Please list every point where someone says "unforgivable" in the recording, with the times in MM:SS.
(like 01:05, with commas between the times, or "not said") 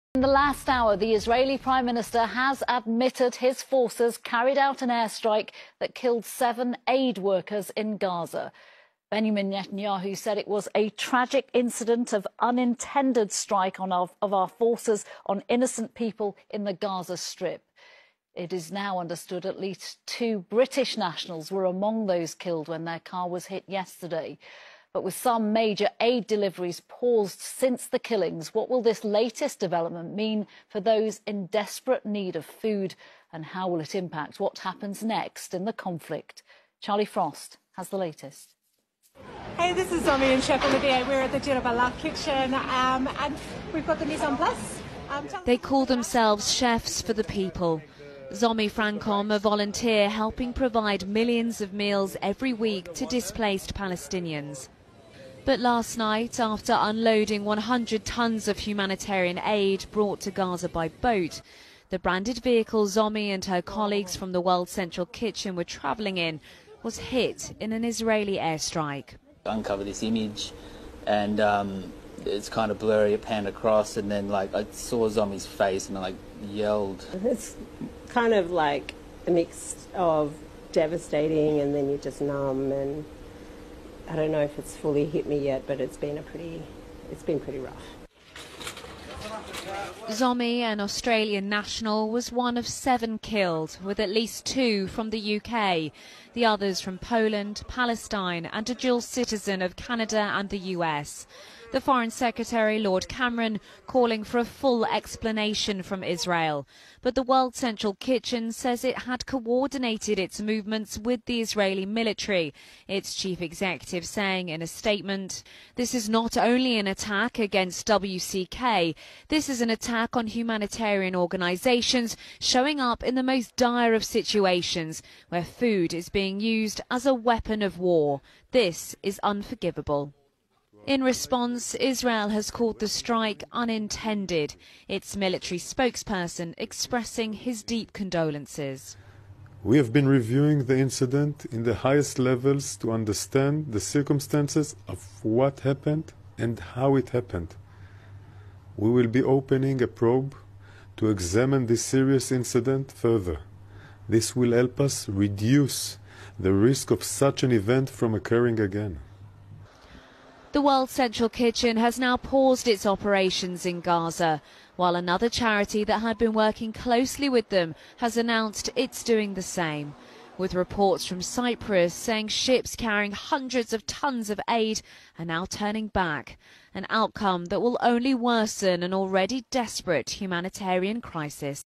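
02:09.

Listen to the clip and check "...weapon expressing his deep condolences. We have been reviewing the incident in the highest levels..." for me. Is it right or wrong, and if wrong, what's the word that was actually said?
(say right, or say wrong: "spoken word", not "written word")
wrong: "spokesperson", not "weapon".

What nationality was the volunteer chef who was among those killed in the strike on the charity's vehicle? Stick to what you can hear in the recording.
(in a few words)
Australian.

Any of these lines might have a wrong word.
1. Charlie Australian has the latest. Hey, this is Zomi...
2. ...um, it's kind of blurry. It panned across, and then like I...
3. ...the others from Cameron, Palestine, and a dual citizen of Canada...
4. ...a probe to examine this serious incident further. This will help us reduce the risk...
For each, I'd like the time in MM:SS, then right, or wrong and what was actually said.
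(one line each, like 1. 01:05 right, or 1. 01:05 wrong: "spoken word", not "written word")
1. 00:36 wrong: "Frost", not "Australian"
2. 01:11 right
3. 01:36 wrong: "Poland", not "Cameron"
4. 02:29 right.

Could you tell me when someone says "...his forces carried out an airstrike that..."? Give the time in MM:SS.
00:03.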